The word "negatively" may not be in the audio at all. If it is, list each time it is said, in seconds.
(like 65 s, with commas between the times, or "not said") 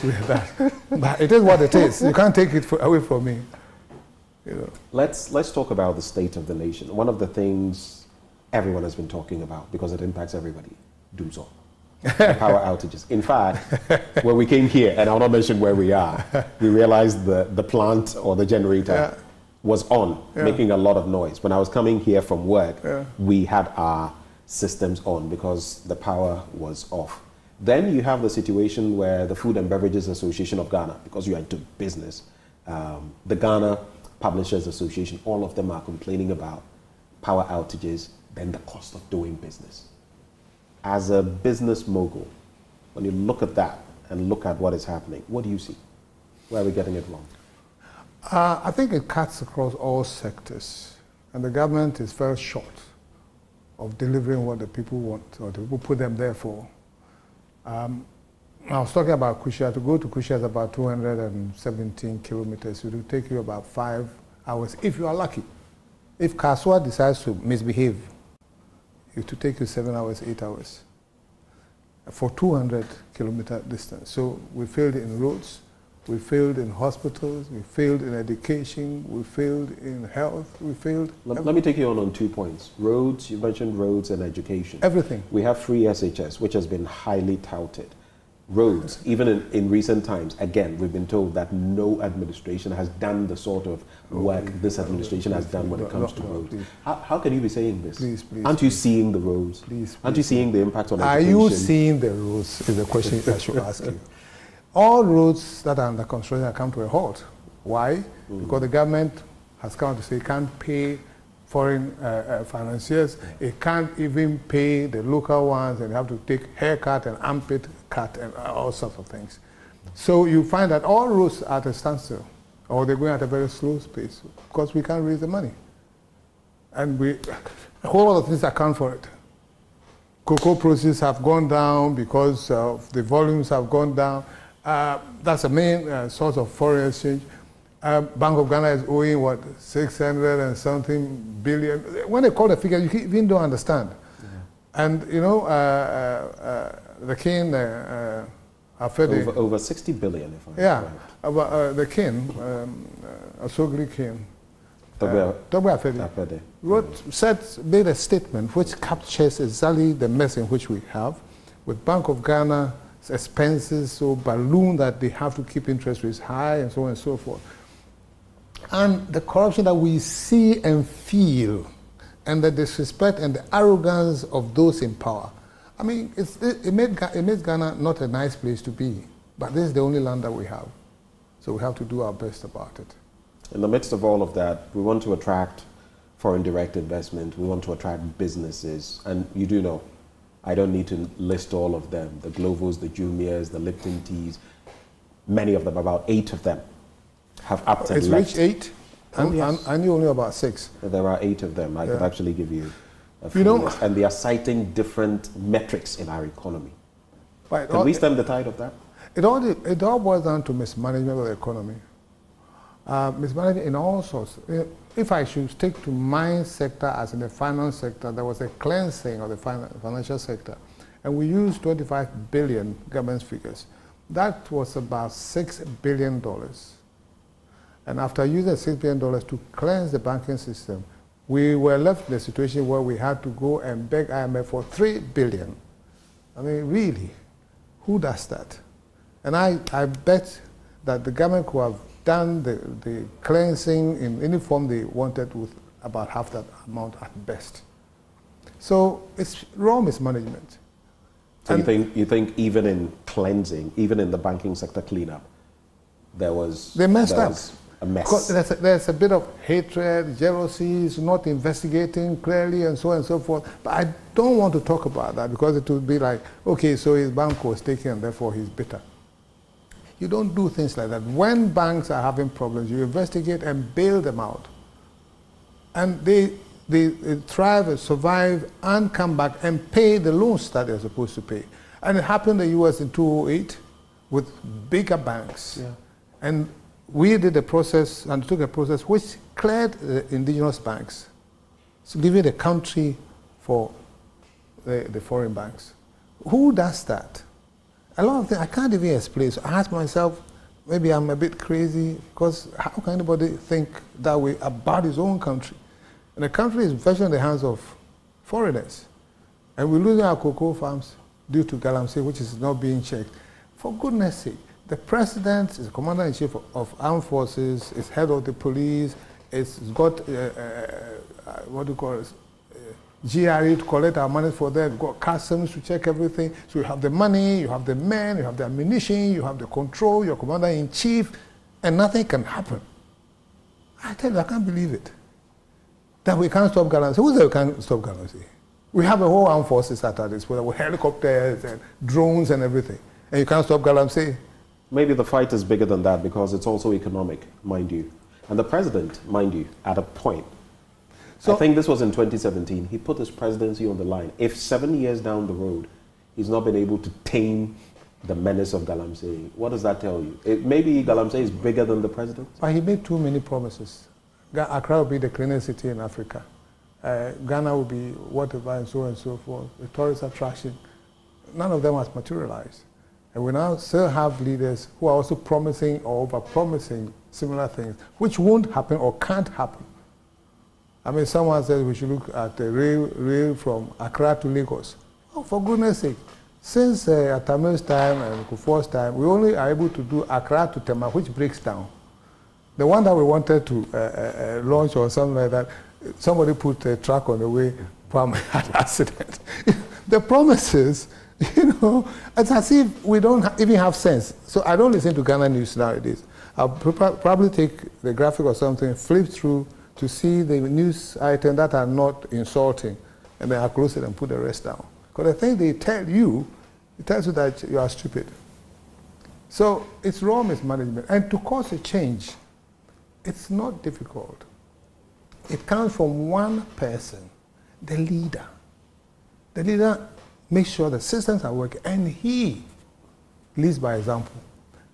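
not said.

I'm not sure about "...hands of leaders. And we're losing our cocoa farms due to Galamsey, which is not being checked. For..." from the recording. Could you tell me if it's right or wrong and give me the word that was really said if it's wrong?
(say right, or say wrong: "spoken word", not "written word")
wrong: "foreigners", not "leaders".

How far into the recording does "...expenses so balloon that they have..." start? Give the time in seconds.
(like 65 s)
163 s.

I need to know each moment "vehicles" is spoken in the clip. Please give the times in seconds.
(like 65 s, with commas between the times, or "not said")
not said.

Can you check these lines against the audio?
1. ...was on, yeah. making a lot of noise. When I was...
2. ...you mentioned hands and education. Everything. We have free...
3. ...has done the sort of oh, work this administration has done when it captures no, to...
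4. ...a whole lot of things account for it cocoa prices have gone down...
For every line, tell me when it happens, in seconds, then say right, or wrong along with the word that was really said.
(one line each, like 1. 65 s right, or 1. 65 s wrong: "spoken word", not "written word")
1. 19 s right
2. 83 s wrong: "roads", not "hands"
3. 92 s wrong: "comes", not "captures"
4. 127 s right.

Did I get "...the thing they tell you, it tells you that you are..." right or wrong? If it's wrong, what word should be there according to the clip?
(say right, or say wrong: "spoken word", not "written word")
right.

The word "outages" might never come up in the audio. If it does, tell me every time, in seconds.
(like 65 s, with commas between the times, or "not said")
12 s, 37 s.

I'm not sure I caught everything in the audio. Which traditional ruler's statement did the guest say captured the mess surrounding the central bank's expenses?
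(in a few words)
Togbe Afede.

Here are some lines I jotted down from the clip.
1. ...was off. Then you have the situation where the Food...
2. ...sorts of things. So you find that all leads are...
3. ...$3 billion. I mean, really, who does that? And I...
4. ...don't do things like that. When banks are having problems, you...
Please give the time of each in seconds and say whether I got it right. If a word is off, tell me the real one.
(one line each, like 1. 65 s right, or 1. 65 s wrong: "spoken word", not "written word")
1. 26 s right
2. 118 s wrong: "roads", not "leads"
3. 234 s right
4. 270 s right.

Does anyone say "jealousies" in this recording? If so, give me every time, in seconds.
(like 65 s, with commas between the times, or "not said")
260 s.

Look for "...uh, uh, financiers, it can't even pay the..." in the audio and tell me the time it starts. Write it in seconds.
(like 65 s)
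112 s.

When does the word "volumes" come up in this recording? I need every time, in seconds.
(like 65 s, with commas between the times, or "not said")
133 s.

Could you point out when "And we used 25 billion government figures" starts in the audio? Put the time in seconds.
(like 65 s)
221 s.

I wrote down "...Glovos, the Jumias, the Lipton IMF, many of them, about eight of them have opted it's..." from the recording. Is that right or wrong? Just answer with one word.
wrong.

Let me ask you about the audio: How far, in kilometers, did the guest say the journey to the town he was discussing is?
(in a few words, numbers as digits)
217.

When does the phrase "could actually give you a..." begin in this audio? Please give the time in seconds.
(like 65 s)
201 s.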